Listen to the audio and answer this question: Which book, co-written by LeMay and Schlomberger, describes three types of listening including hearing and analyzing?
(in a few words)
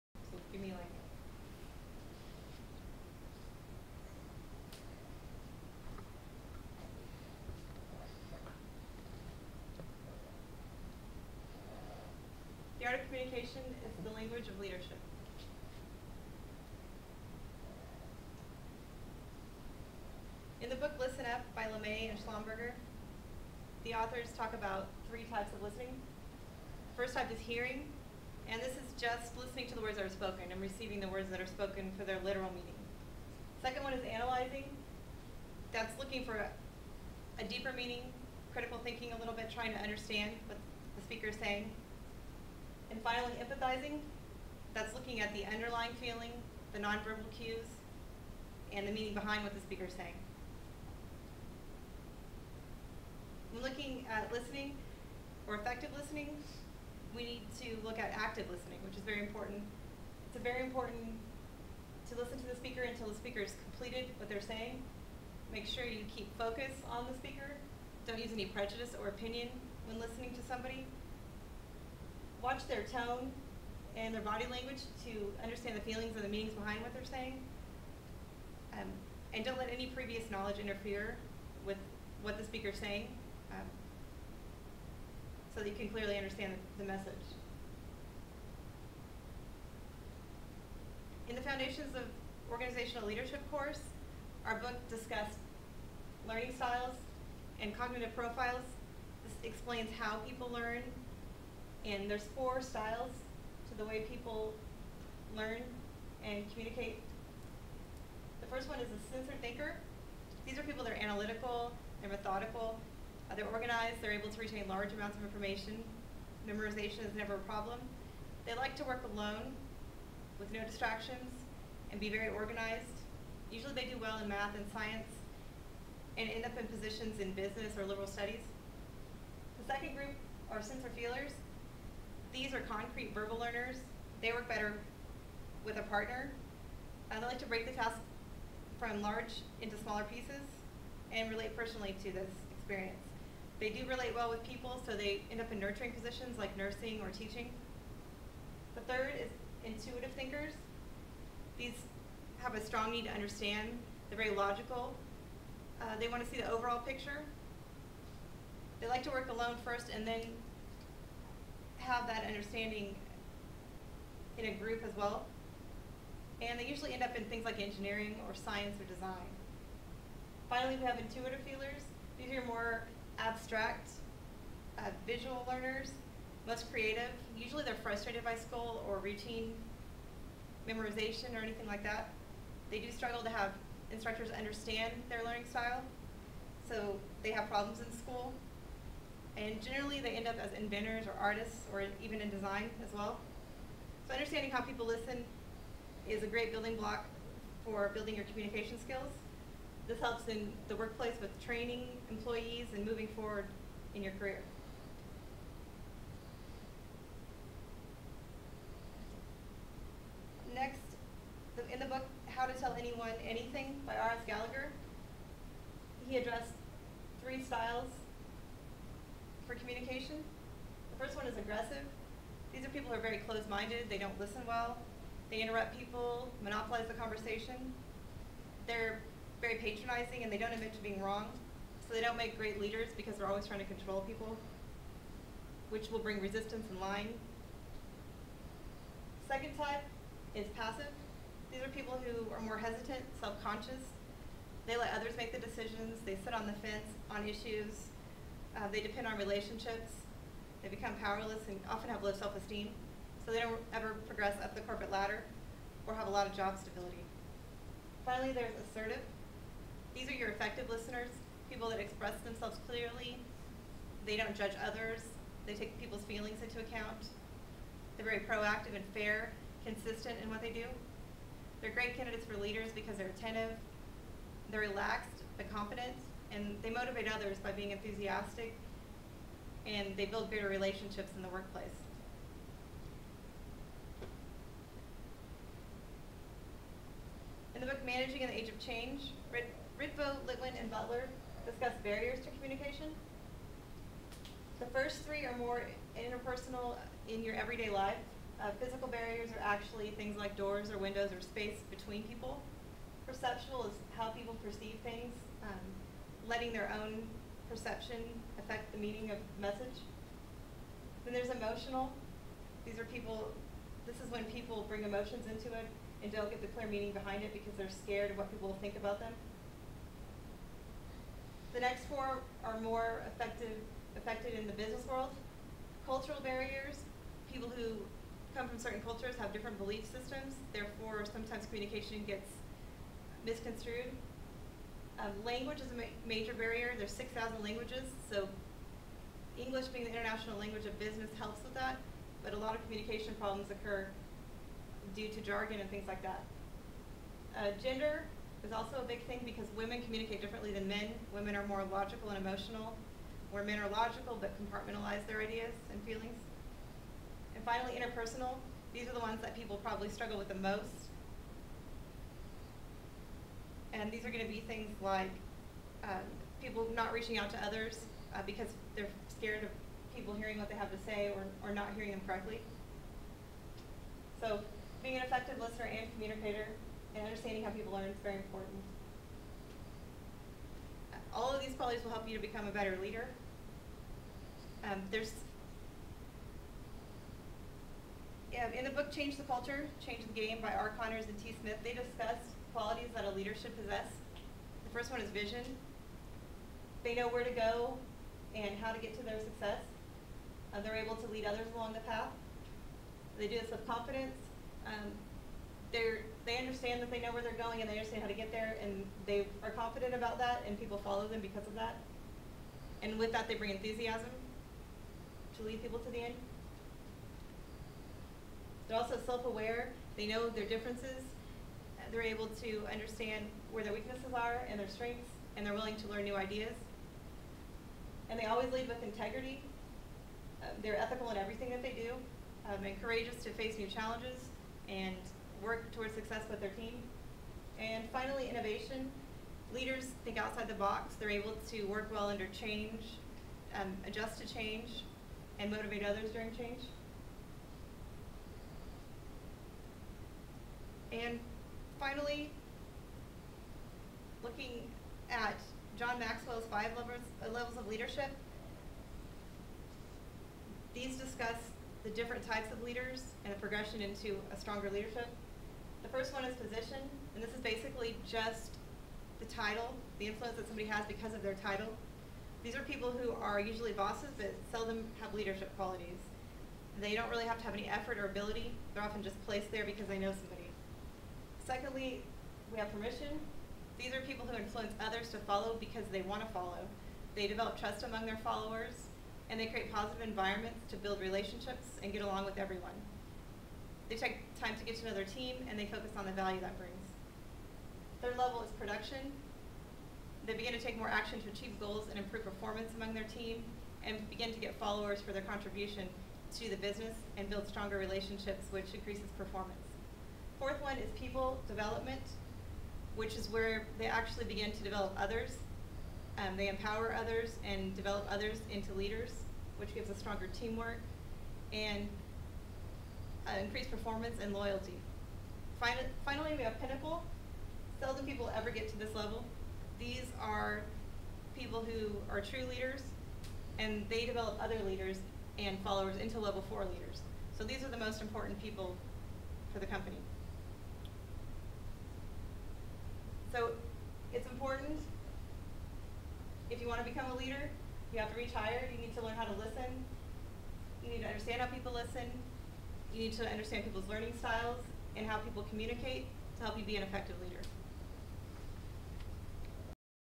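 Listen Up.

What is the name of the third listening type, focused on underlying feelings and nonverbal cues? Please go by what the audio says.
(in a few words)
Empathizing.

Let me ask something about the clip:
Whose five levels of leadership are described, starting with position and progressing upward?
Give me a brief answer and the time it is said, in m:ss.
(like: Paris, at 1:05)
John Maxwell, at 7:35.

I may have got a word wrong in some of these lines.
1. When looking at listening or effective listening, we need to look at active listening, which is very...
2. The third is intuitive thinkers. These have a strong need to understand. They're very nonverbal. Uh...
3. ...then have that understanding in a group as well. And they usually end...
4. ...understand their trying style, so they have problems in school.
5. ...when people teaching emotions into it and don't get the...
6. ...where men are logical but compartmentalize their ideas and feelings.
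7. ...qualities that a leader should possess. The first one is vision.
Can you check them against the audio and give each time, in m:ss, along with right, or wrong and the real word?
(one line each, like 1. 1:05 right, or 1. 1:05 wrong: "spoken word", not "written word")
1. 0:53 right
2. 2:28 wrong: "logical", not "nonverbal"
3. 2:40 right
4. 3:04 wrong: "learning", not "trying"
5. 5:14 wrong: "bring", not "teaching"
6. 5:53 right
7. 6:32 right.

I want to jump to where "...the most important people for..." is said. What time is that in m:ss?
8:57.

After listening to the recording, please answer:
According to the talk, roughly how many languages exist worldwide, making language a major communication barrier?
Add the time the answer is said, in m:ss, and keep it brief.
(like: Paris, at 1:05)
6,000, at 5:36.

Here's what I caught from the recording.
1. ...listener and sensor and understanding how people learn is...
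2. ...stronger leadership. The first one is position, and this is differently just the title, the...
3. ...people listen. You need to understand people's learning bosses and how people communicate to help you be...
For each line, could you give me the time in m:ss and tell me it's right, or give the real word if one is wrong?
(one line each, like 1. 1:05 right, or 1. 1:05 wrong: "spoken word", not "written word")
1. 6:15 wrong: "communicator", not "sensor"
2. 7:44 wrong: "basically", not "differently"
3. 9:11 wrong: "styles", not "bosses".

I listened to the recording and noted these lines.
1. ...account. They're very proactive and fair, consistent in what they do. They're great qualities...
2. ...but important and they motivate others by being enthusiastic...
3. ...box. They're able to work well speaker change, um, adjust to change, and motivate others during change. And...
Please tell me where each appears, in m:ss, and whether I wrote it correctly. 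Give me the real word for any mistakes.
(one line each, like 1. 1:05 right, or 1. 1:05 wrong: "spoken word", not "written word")
1. 4:26 wrong: "candidates", not "qualities"
2. 4:35 wrong: "confident", not "important"
3. 7:20 wrong: "under", not "speaker".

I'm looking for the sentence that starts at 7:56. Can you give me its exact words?
They don't really have to have any effort or ability.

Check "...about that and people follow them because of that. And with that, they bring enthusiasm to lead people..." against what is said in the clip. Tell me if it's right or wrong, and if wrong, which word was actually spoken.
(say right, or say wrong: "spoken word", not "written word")
right.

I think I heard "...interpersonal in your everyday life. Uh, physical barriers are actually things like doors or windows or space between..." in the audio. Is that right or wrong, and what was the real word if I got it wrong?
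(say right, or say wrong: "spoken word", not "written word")
right.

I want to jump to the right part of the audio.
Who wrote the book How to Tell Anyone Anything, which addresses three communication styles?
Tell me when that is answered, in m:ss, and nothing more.
3:33.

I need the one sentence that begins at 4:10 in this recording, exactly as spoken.
They become powerless and often have low self-esteem.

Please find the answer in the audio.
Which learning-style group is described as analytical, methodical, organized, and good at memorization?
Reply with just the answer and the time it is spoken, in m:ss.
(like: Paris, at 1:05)
Sensor thinker, at 1:49.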